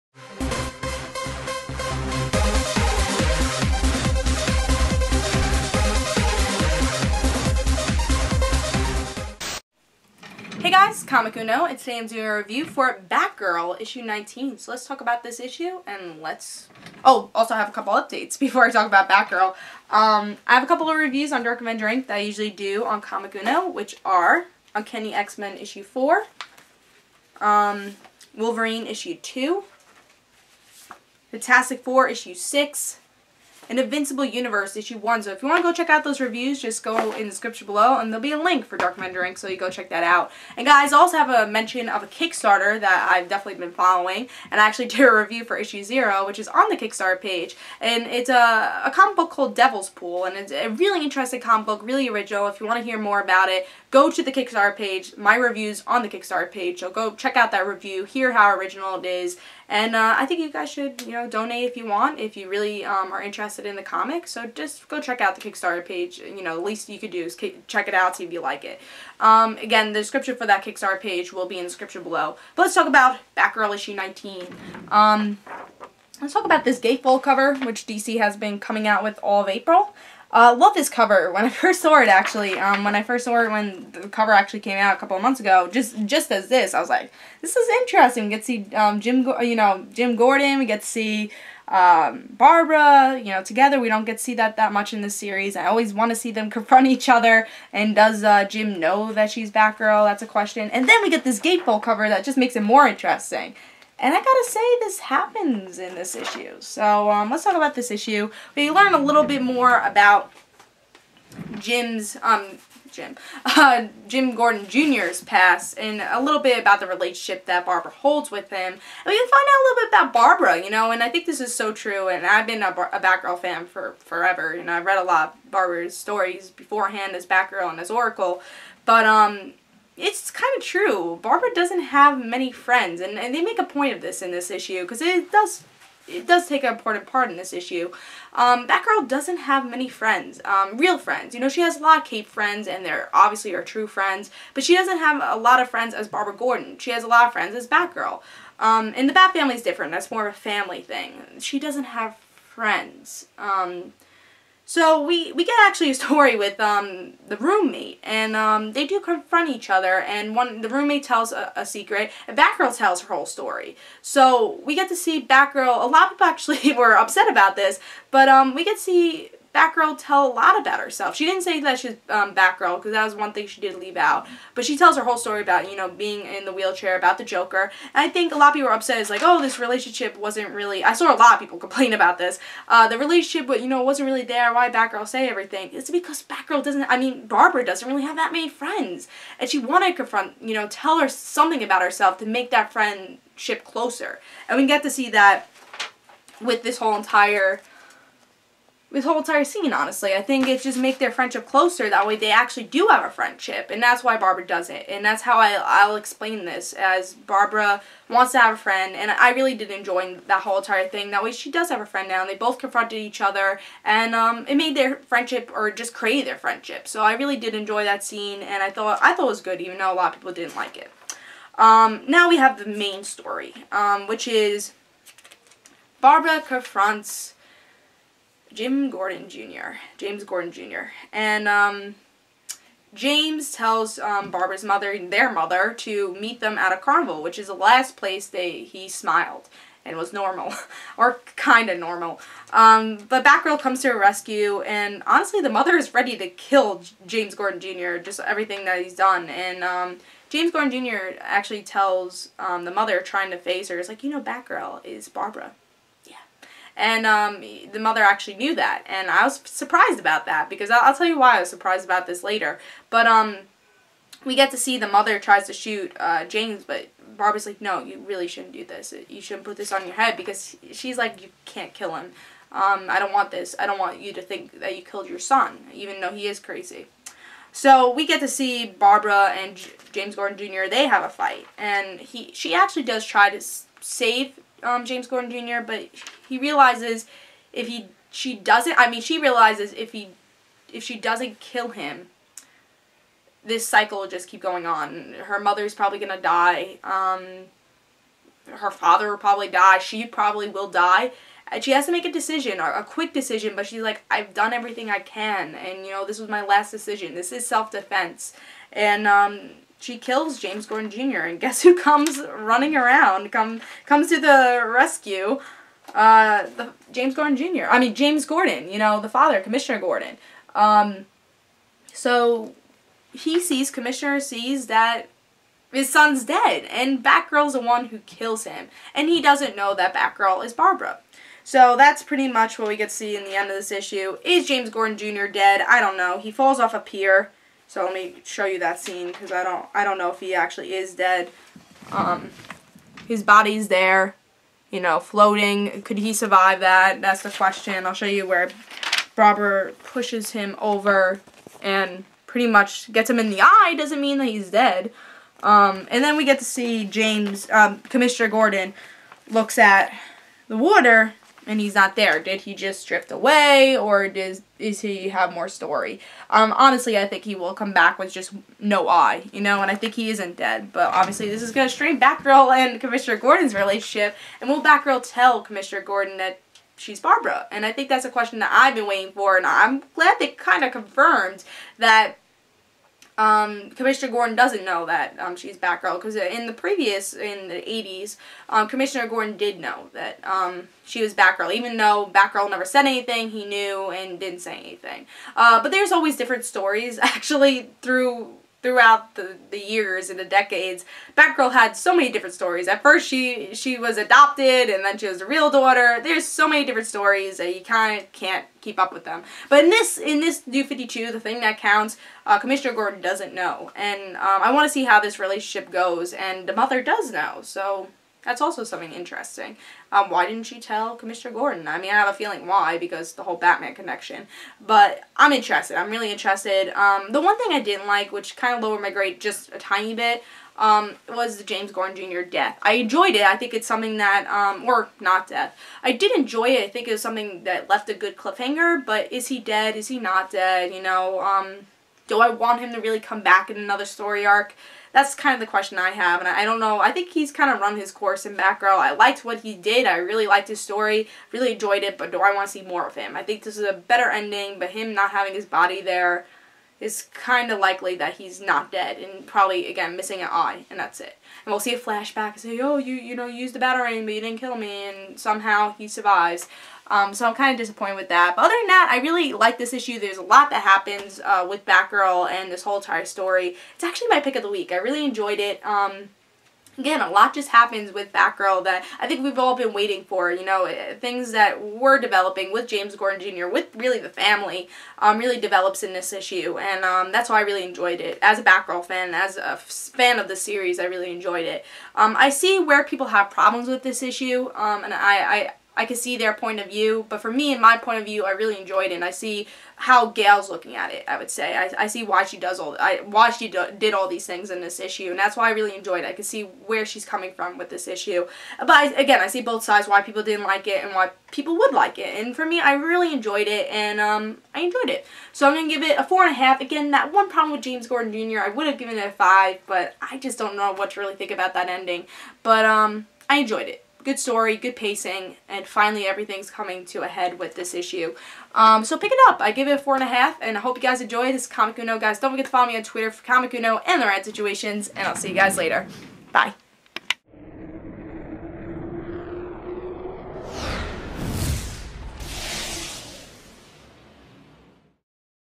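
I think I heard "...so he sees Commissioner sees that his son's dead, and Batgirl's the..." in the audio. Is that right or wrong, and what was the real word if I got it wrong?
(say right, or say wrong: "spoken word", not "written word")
right.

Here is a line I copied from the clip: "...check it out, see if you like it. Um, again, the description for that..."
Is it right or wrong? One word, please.
right.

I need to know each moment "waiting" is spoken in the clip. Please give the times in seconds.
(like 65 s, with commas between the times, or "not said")
378 s, 479 s.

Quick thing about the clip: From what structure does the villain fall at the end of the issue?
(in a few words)
A pier.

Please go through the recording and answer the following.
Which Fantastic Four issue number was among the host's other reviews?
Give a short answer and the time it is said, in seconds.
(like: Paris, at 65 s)
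6, at 31 s.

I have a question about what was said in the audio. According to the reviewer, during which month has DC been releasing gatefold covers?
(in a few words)
April.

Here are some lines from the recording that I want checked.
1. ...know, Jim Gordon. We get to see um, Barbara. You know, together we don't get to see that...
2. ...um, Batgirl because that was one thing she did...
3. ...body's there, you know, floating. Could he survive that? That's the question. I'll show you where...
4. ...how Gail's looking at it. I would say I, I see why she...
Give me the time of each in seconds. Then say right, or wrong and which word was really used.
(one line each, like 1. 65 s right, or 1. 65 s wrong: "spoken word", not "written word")
1. 89 s right
2. 172 s right
3. 343 s right
4. 499 s right.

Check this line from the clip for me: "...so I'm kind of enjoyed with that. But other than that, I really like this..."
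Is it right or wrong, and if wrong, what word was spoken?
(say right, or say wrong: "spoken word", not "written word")
wrong: "disappointed", not "enjoyed".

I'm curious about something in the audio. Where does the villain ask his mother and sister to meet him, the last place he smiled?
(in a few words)
A carnival.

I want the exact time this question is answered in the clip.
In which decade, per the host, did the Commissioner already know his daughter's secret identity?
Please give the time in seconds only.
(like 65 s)
387 s.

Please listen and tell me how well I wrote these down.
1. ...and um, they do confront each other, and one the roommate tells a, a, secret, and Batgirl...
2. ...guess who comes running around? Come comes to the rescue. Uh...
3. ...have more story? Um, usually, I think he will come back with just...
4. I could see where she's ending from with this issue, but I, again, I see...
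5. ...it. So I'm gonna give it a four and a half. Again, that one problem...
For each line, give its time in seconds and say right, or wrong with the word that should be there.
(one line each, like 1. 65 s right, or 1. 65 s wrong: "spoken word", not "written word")
1. 158 s right
2. 311 s right
3. 365 s wrong: "honestly", not "usually"
4. 506 s wrong: "coming", not "ending"
5. 514 s right.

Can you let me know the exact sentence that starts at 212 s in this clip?
And they both confronted each other.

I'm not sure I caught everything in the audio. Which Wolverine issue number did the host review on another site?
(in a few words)
2.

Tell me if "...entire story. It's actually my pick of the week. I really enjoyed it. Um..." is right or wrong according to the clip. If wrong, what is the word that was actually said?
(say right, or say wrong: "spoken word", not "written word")
right.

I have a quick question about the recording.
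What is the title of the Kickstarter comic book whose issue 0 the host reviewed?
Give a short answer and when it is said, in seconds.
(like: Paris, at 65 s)
Devil's Pool, at 49 s.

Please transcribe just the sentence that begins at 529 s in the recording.
I give it a four and a half, and I hope you guys enjoy this Comic Uno.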